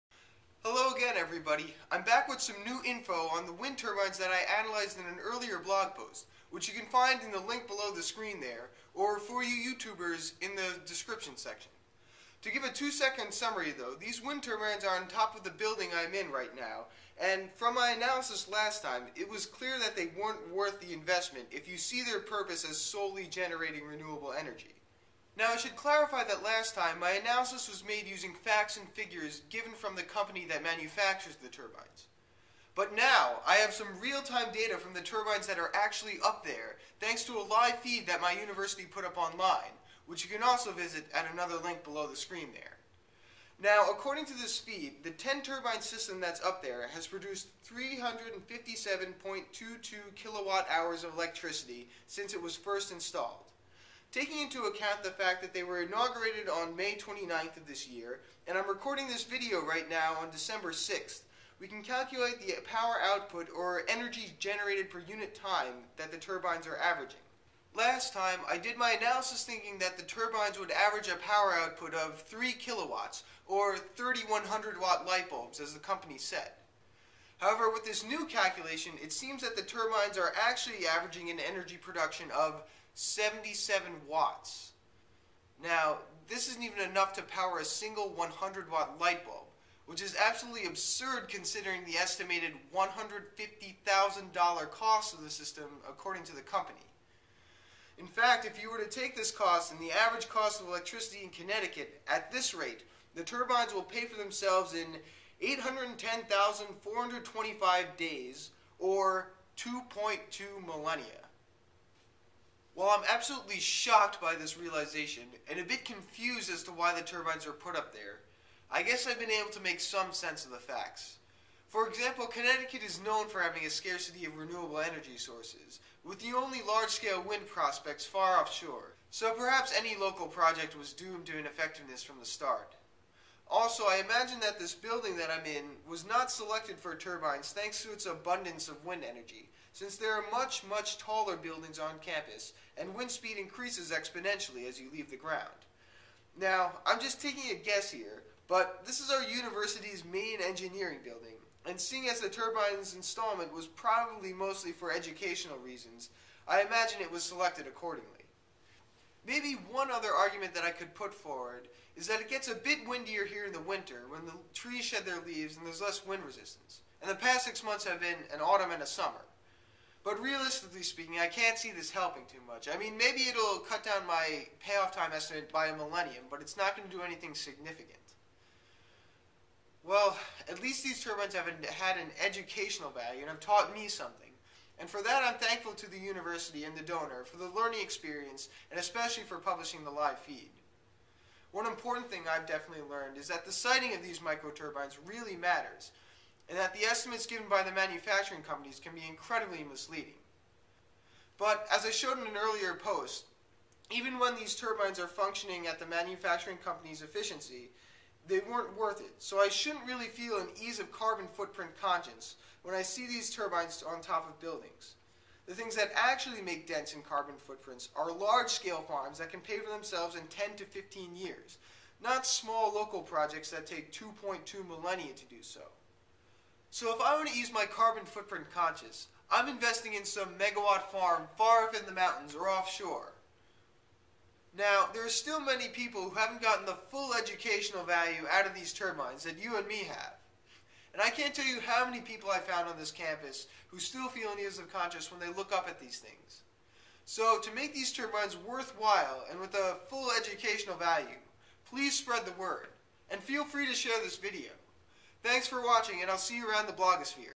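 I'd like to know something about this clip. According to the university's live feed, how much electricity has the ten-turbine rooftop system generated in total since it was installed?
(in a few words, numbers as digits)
357.22 kilowatt-hours.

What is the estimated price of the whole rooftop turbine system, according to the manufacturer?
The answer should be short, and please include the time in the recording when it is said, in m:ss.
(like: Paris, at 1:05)
$150,000, at 1:32.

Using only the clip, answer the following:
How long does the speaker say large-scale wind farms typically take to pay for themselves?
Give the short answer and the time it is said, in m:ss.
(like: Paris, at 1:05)
10 to 15 years, at 3:40.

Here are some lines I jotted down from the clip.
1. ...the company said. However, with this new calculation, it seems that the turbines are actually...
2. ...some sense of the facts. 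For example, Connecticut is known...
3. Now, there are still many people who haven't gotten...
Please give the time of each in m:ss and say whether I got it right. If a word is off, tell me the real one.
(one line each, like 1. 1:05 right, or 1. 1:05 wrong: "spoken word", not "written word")
1. 1:15 right
2. 1:59 right
3. 3:54 right.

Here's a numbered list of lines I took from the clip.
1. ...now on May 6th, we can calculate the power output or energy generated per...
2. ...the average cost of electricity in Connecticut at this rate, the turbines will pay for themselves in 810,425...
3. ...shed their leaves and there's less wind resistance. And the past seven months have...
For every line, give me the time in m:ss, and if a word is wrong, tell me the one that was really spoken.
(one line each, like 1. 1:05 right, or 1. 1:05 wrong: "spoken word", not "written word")
1. 0:59 wrong: "December", not "May"
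2. 1:39 right
3. 2:44 wrong: "six", not "seven".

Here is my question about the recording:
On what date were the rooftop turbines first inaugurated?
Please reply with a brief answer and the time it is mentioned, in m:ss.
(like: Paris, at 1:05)
May 29th, at 0:56.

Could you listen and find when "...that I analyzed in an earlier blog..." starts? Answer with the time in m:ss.
0:04.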